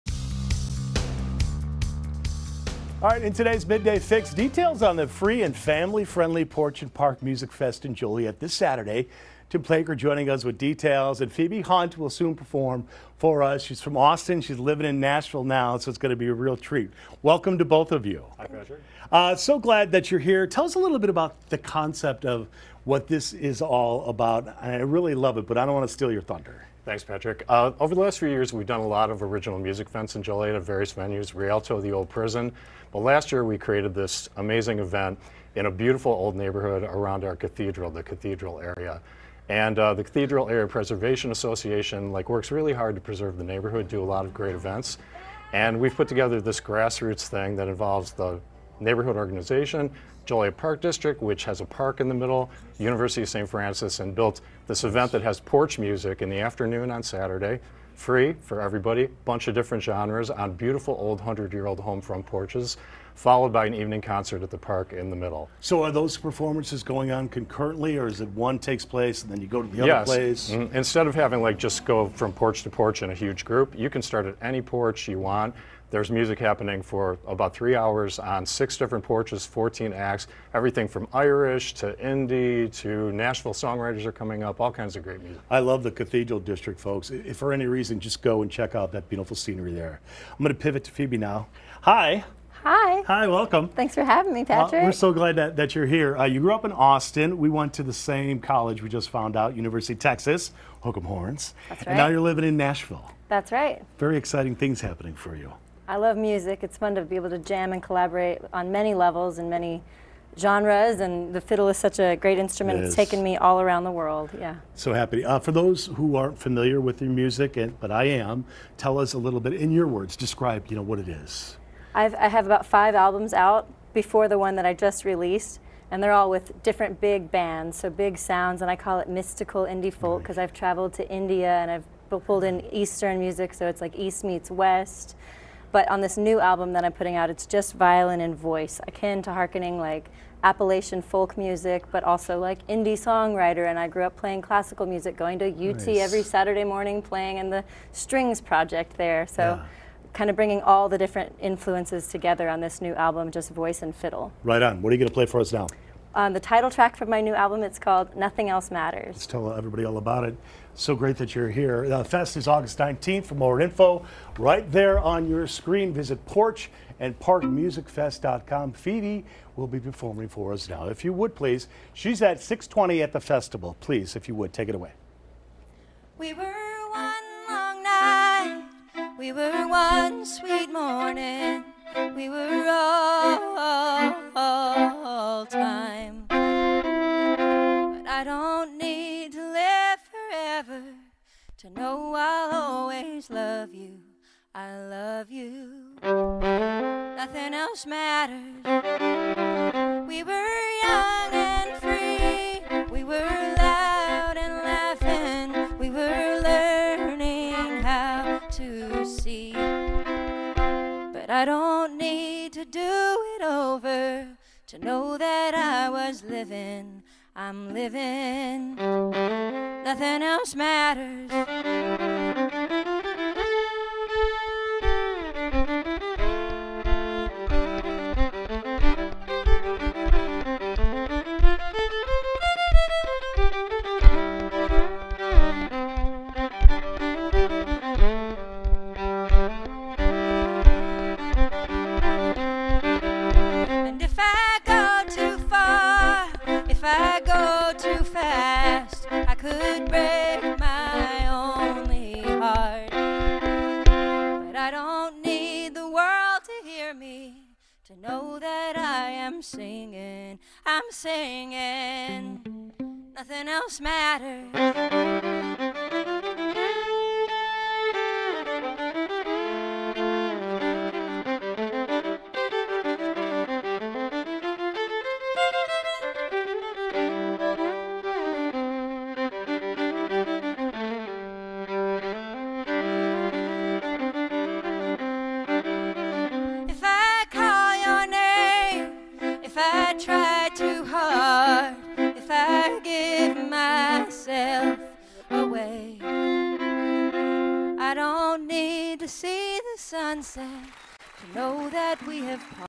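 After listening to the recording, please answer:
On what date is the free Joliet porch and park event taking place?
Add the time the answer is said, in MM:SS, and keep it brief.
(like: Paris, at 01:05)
August 19, at 02:42.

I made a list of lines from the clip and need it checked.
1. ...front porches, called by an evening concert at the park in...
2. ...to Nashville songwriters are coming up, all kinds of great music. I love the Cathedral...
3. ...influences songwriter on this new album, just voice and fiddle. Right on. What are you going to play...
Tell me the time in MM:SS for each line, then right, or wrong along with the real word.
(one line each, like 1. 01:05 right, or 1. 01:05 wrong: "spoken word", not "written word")
1. 01:02 wrong: "followed", not "called"
2. 01:22 right
3. 02:31 wrong: "together", not "songwriter".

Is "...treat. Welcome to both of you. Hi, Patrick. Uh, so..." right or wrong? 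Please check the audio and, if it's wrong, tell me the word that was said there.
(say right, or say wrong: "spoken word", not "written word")
right.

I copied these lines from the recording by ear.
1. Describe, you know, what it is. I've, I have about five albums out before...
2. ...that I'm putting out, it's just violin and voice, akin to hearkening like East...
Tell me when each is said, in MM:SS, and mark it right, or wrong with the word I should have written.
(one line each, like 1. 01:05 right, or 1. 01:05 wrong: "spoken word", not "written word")
1. 02:00 right
2. 02:16 wrong: "Appalachian", not "East".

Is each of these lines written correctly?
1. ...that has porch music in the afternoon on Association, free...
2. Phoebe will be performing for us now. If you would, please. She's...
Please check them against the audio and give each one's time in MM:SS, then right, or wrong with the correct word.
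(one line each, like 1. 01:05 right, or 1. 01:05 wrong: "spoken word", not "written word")
1. 00:55 wrong: "Saturday", not "Association"
2. 02:48 right.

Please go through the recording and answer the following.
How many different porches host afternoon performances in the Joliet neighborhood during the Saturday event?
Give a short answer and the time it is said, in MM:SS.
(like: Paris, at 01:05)
6, at 01:18.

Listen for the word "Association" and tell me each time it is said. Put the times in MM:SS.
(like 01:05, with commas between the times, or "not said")
00:41.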